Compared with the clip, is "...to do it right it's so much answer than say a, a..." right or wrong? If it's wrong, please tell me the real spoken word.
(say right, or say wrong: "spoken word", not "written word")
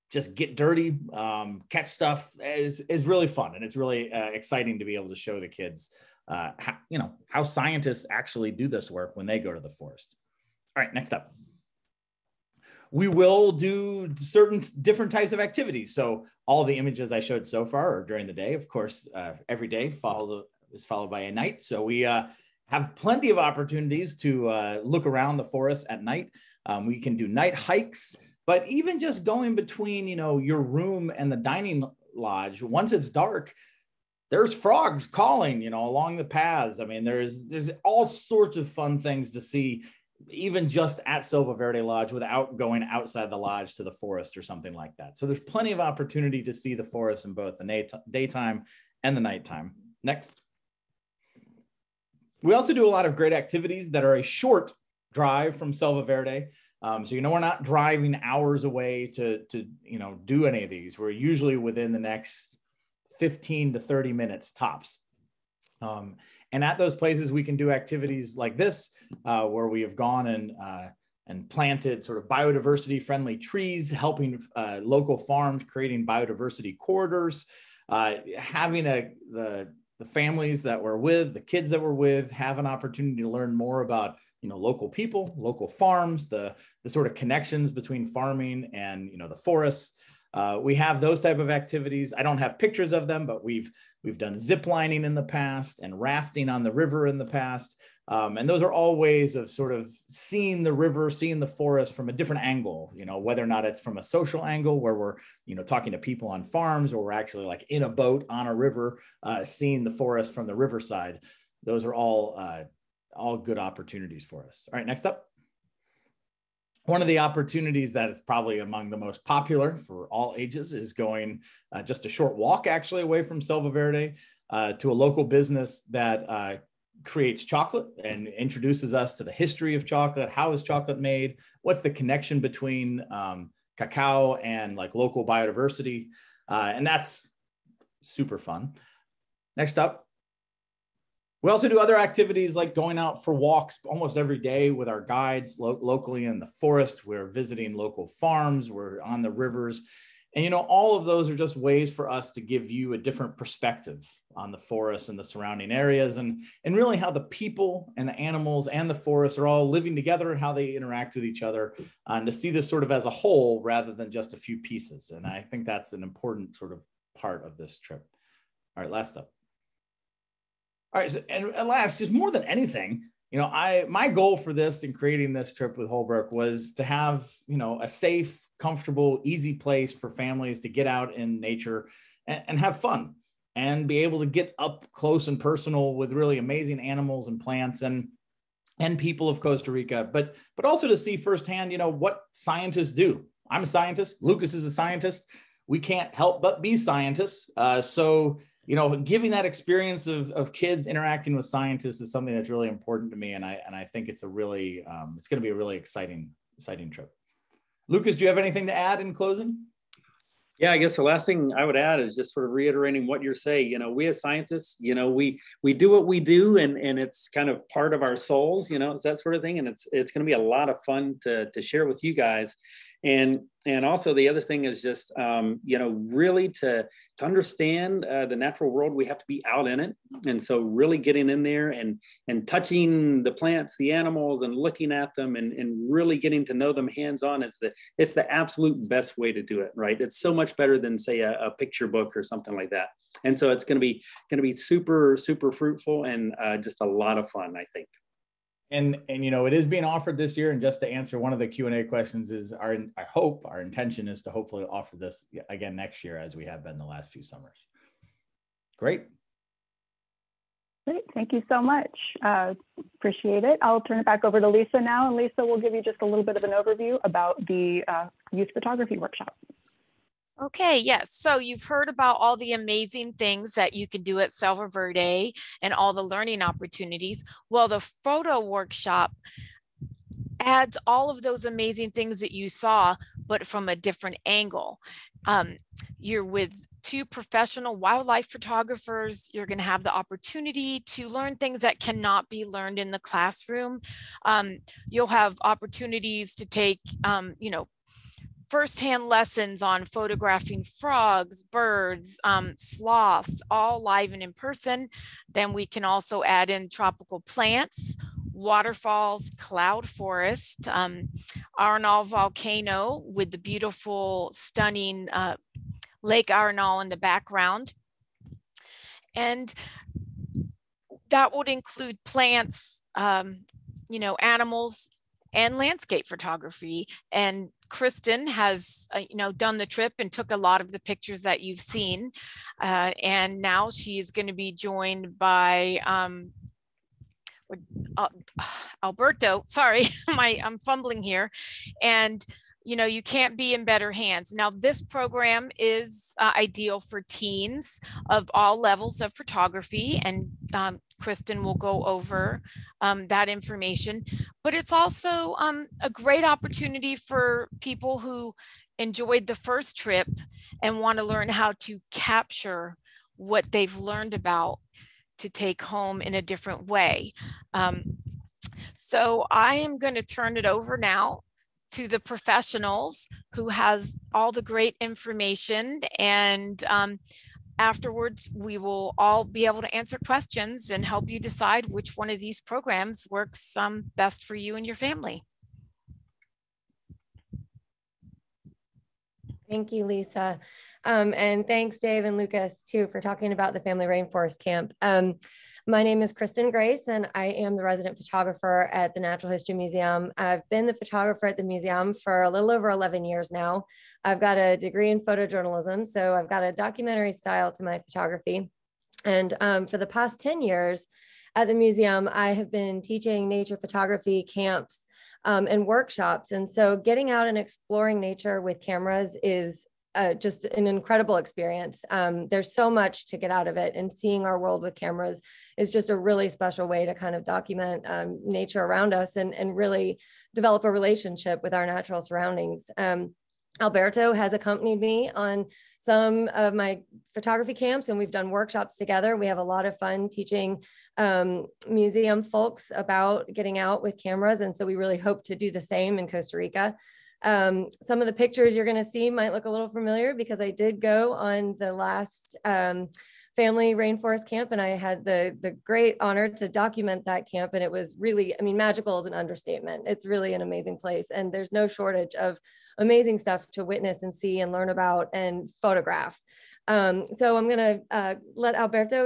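wrong: "better", not "answer".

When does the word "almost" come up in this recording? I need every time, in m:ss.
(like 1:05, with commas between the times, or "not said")
2:23.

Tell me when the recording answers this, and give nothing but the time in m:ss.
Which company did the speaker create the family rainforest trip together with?
2:55.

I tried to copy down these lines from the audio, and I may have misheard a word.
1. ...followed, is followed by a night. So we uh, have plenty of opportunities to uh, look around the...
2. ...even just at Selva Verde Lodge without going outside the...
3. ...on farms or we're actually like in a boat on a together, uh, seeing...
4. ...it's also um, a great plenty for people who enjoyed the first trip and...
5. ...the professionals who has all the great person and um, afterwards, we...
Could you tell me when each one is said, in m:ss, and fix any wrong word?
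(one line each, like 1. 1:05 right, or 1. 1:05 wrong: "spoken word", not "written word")
1. 0:19 right
2. 0:40 right
3. 1:46 wrong: "river", not "together"
4. 5:54 wrong: "opportunity", not "plenty"
5. 6:11 wrong: "information", not "person".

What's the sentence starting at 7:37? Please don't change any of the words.
And it was really, I mean, magical is an understatement.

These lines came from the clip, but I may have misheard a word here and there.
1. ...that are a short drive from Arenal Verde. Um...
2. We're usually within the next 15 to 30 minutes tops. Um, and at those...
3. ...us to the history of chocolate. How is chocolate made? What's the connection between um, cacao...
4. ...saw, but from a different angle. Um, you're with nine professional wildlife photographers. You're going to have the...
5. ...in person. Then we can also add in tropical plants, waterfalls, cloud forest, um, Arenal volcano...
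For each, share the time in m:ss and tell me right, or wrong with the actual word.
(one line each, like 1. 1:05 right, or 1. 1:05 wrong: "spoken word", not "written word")
1. 0:53 wrong: "Selva", not "Arenal"
2. 1:00 right
3. 2:08 right
4. 4:42 wrong: "two", not "nine"
5. 5:04 right.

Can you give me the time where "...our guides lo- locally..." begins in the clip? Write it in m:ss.
2:24.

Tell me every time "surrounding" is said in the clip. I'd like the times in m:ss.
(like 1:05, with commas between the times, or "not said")
2:35, 7:12.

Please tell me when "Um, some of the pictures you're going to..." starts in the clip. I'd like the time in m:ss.
7:27.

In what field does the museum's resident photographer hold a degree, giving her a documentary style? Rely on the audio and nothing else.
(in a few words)
Photojournalism.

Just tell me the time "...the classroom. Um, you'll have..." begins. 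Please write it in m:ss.
4:52.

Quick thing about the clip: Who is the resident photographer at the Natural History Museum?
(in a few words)
Kristen Grace.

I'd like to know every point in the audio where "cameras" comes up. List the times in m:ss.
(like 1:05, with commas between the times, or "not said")
6:58, 7:04, 7:24.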